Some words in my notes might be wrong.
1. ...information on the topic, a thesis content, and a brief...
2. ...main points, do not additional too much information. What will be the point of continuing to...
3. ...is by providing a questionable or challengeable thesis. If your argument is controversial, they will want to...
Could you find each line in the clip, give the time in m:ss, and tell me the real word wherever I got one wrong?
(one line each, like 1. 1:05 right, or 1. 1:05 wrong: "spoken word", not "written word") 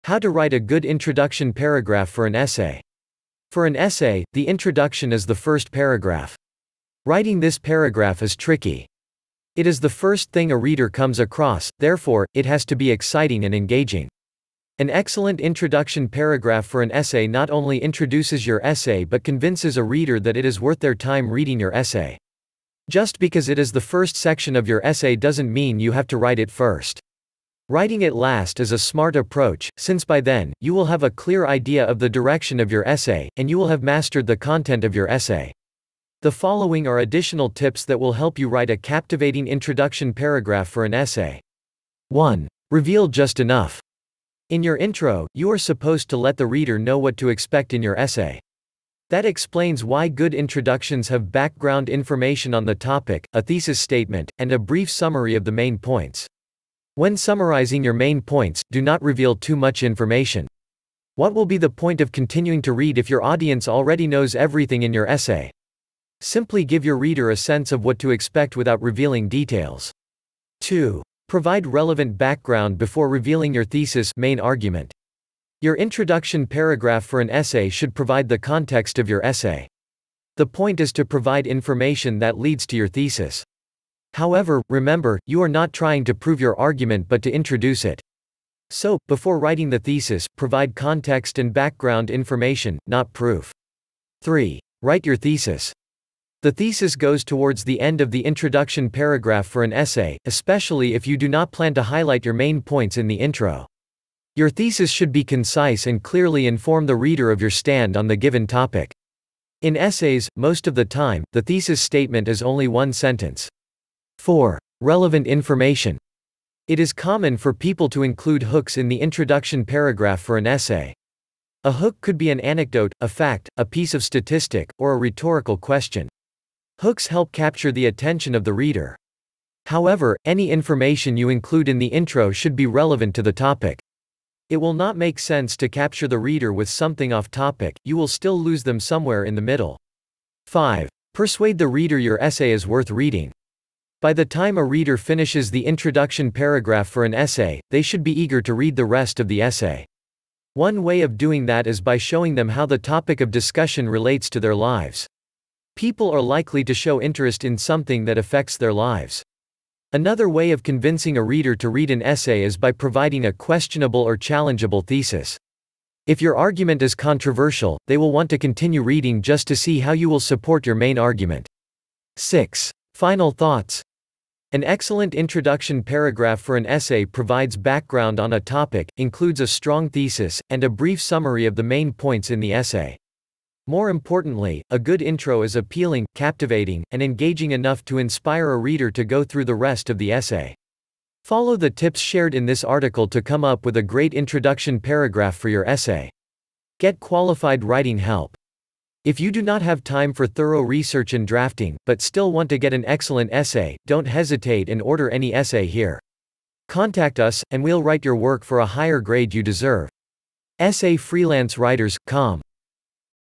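1. 0:51 wrong: "statement", not "content"
2. 0:57 wrong: "reveal", not "additional"
3. 2:42 right.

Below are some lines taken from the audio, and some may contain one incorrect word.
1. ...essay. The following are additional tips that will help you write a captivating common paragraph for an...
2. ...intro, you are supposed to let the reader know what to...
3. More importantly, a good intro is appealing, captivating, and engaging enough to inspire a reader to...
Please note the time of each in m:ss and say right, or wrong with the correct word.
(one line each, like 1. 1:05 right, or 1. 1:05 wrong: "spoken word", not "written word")
1. 0:35 wrong: "introduction", not "common"
2. 0:44 right
3. 3:03 right.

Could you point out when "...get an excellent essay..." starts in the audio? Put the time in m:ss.
3:22.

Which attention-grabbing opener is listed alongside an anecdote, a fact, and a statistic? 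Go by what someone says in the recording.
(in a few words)
Rhetorical question.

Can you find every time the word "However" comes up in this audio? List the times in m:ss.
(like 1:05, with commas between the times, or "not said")
1:24, 2:09.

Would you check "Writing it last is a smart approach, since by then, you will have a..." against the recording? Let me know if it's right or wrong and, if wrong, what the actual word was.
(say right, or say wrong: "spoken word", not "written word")
right.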